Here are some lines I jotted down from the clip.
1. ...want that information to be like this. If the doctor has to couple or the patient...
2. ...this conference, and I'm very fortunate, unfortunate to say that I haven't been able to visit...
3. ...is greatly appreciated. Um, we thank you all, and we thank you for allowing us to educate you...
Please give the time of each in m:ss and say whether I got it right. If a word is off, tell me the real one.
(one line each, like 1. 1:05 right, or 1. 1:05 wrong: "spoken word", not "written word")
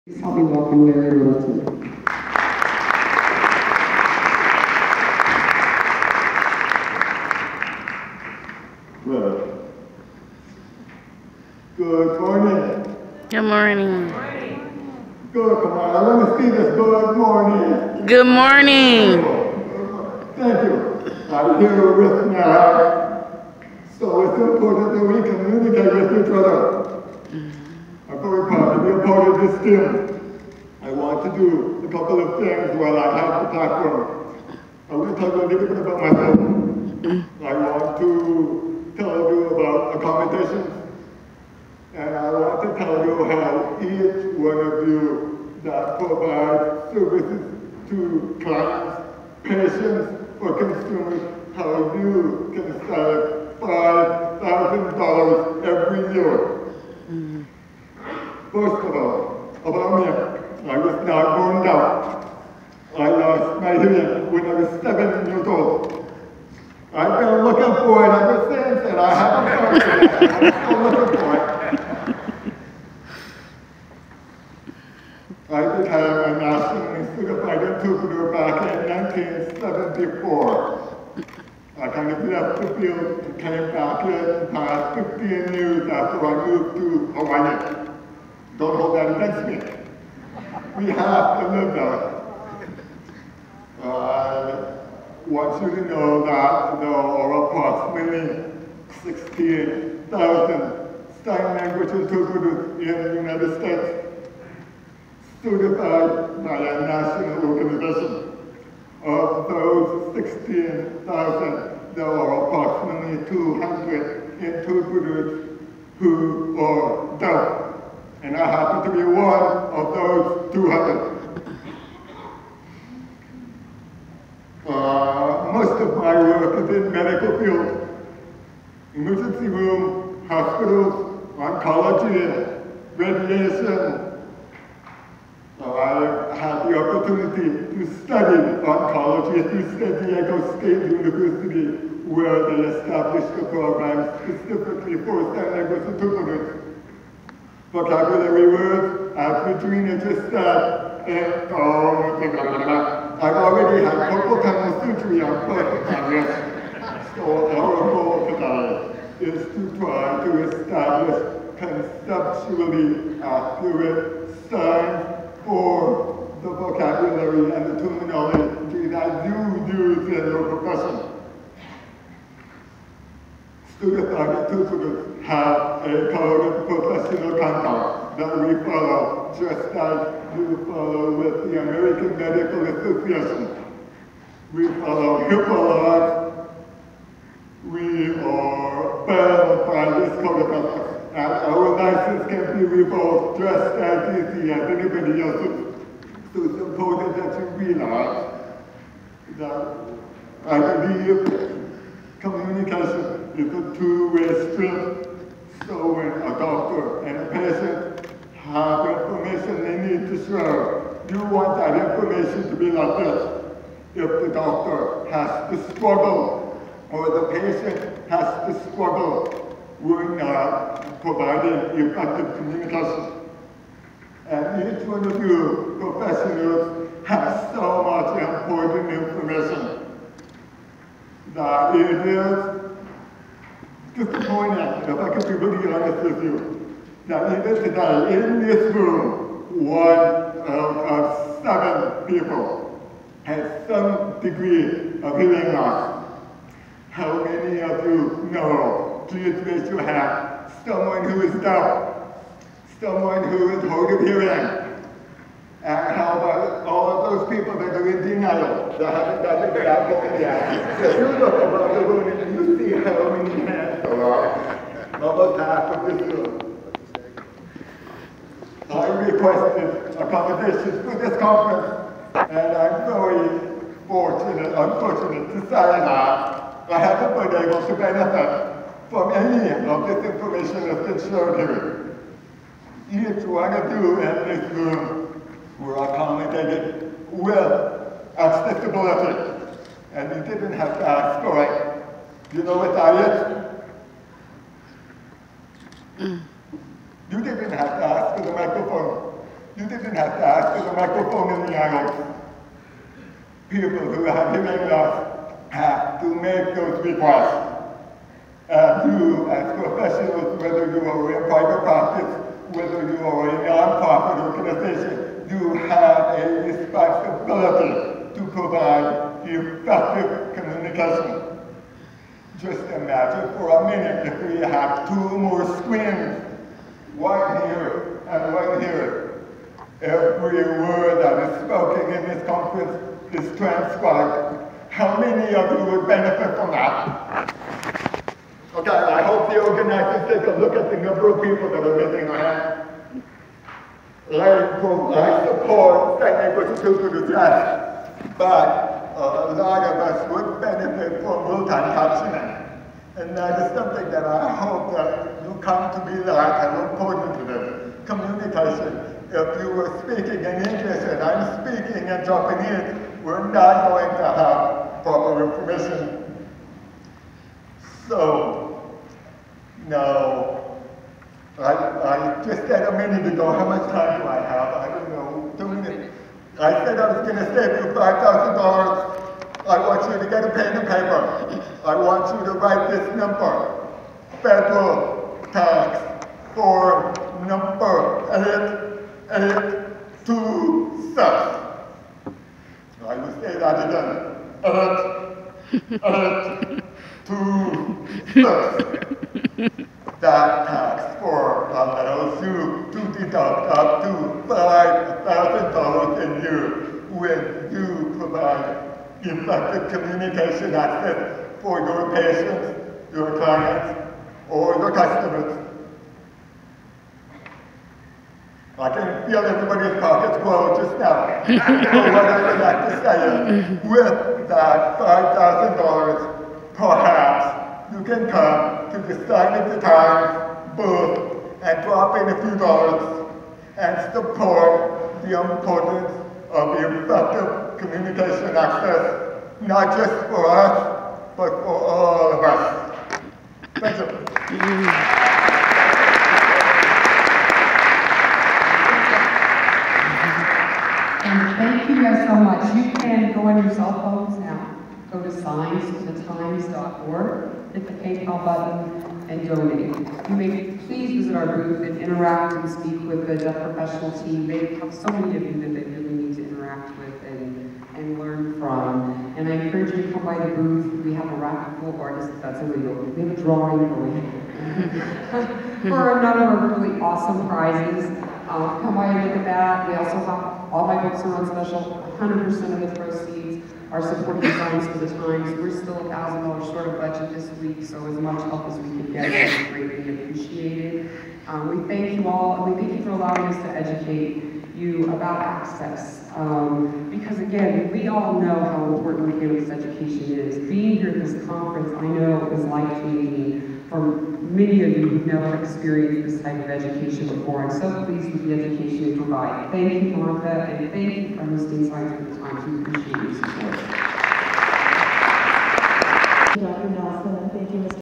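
1. 3:31 wrong: "struggle", not "couple"
2. 4:30 wrong: "benefit", not "visit"
3. 8:09 right.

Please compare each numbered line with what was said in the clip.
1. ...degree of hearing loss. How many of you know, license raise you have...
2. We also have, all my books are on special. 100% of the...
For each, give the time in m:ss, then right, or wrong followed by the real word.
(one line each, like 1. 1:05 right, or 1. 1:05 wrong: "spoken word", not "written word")
1. 4:04 wrong: "please", not "license"
2. 7:59 right.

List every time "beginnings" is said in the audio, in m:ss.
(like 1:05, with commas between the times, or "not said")
8:19.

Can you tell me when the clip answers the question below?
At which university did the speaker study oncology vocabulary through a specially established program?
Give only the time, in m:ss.
2:19.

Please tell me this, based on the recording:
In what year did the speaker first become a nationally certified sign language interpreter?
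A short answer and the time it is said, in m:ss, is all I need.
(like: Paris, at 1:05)
1974, at 1:19.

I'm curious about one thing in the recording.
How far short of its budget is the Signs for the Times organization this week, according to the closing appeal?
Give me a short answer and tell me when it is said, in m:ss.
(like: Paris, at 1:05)
$1,000, at 8:05.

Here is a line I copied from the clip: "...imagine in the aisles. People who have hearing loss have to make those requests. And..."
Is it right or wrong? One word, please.
wrong.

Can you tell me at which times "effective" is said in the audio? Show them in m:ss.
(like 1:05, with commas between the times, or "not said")
3:41, 5:19, 6:49, 7:16.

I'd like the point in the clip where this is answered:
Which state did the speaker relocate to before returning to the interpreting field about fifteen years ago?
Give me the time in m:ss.
1:27.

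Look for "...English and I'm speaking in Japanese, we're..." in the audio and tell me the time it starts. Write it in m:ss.
6:00.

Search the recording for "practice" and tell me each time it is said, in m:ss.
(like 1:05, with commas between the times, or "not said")
5:11.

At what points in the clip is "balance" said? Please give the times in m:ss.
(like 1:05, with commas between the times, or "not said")
not said.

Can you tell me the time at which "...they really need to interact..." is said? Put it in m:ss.
7:45.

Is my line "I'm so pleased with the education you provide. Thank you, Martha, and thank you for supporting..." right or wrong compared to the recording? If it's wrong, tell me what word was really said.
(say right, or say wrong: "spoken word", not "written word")
wrong: "hosting", not "supporting".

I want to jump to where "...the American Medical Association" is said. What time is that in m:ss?
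3:01.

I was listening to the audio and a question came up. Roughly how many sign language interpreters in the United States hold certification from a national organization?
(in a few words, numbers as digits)
16,000.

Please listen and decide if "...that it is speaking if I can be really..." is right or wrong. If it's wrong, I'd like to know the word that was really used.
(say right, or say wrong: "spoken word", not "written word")
wrong: "disappointing", not "speaking".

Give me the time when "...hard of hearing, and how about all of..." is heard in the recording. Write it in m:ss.
4:13.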